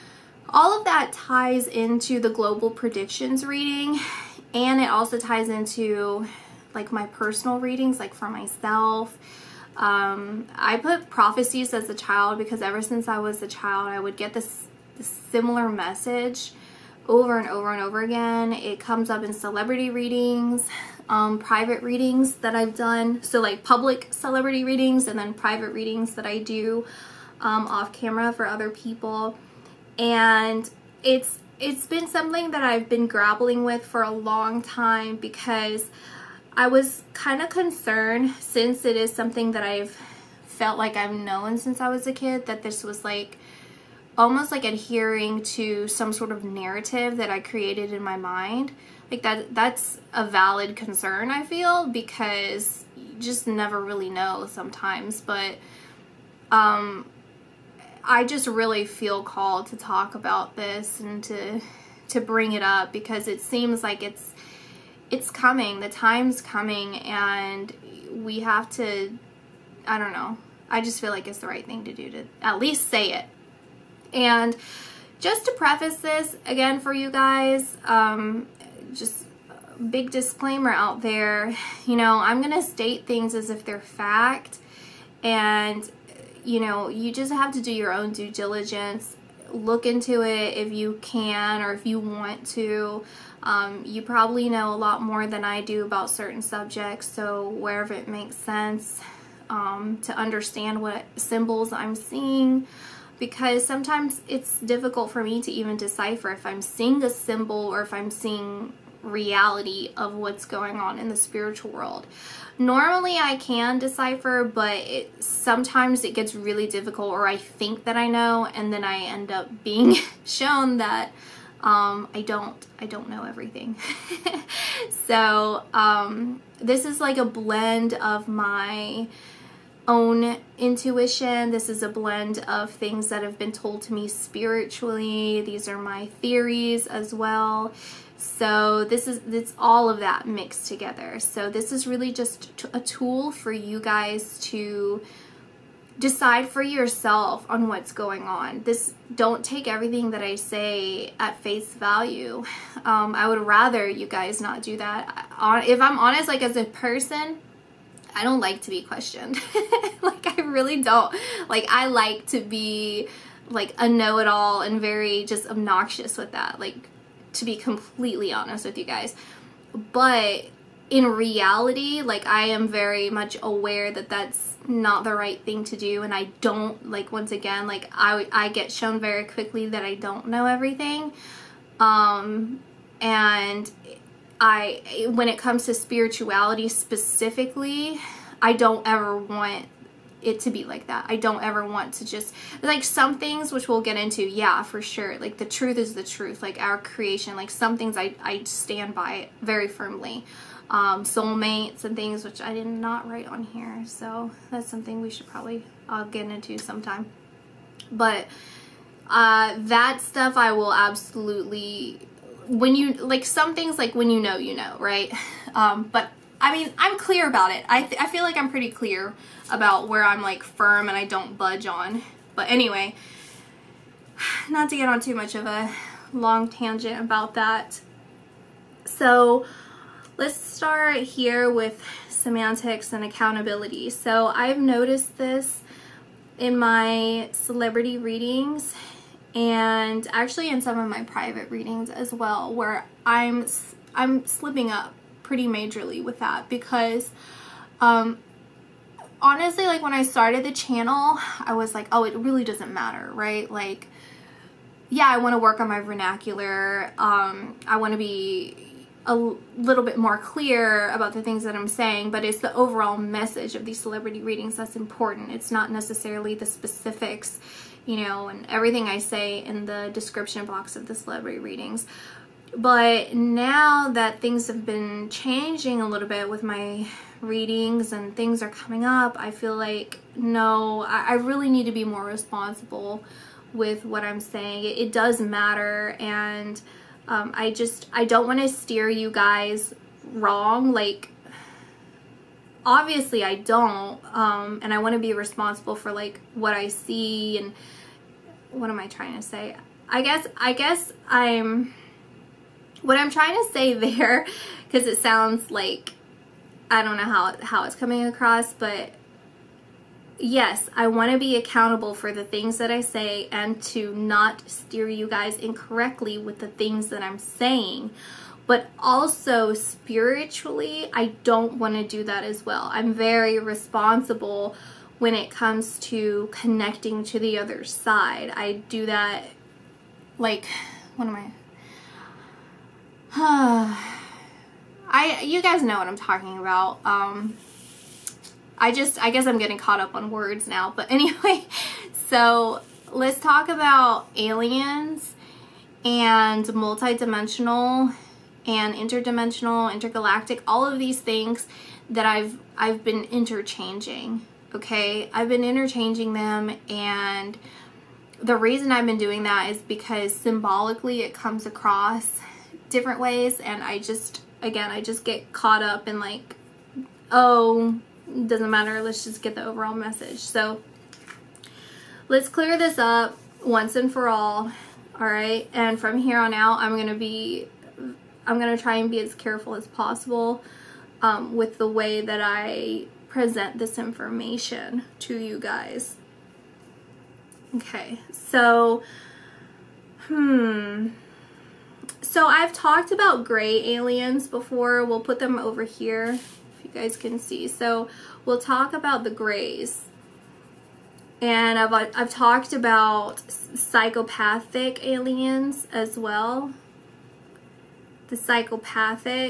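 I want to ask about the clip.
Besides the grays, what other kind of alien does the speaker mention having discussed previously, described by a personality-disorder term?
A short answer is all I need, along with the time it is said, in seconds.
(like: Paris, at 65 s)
Psychopathic aliens, at 403 s.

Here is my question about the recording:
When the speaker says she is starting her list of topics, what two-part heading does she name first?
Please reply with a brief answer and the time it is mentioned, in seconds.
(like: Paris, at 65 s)
Semantics and accountability, at 232 s.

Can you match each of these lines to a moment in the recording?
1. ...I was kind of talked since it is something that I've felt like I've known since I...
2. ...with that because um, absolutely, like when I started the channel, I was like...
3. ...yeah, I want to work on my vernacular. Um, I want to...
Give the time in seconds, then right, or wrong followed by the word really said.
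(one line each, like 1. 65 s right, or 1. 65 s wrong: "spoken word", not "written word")
1. 36 s wrong: "concerned", not "talked"
2. 246 s wrong: "honestly", not "absolutely"
3. 254 s right.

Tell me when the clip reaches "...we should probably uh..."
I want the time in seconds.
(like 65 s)
205 s.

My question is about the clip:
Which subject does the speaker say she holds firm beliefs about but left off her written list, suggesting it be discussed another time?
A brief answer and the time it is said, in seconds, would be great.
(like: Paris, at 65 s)
Soulmates, at 201 s.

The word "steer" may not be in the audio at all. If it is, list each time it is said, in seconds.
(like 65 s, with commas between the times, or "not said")
288 s, 314 s.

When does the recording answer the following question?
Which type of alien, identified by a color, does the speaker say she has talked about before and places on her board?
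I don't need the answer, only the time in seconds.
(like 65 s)
393 s.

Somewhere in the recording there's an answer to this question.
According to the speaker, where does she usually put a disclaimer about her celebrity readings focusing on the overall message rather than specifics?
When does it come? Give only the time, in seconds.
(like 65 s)
269 s.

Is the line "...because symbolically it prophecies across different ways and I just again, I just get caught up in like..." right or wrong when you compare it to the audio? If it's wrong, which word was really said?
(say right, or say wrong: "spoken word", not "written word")
wrong: "comes", not "prophecies".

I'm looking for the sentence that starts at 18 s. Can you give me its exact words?
It comes up in celebrity readings, um, private readings that I've done.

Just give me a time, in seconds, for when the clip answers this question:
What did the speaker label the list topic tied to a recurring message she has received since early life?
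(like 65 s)
11 s.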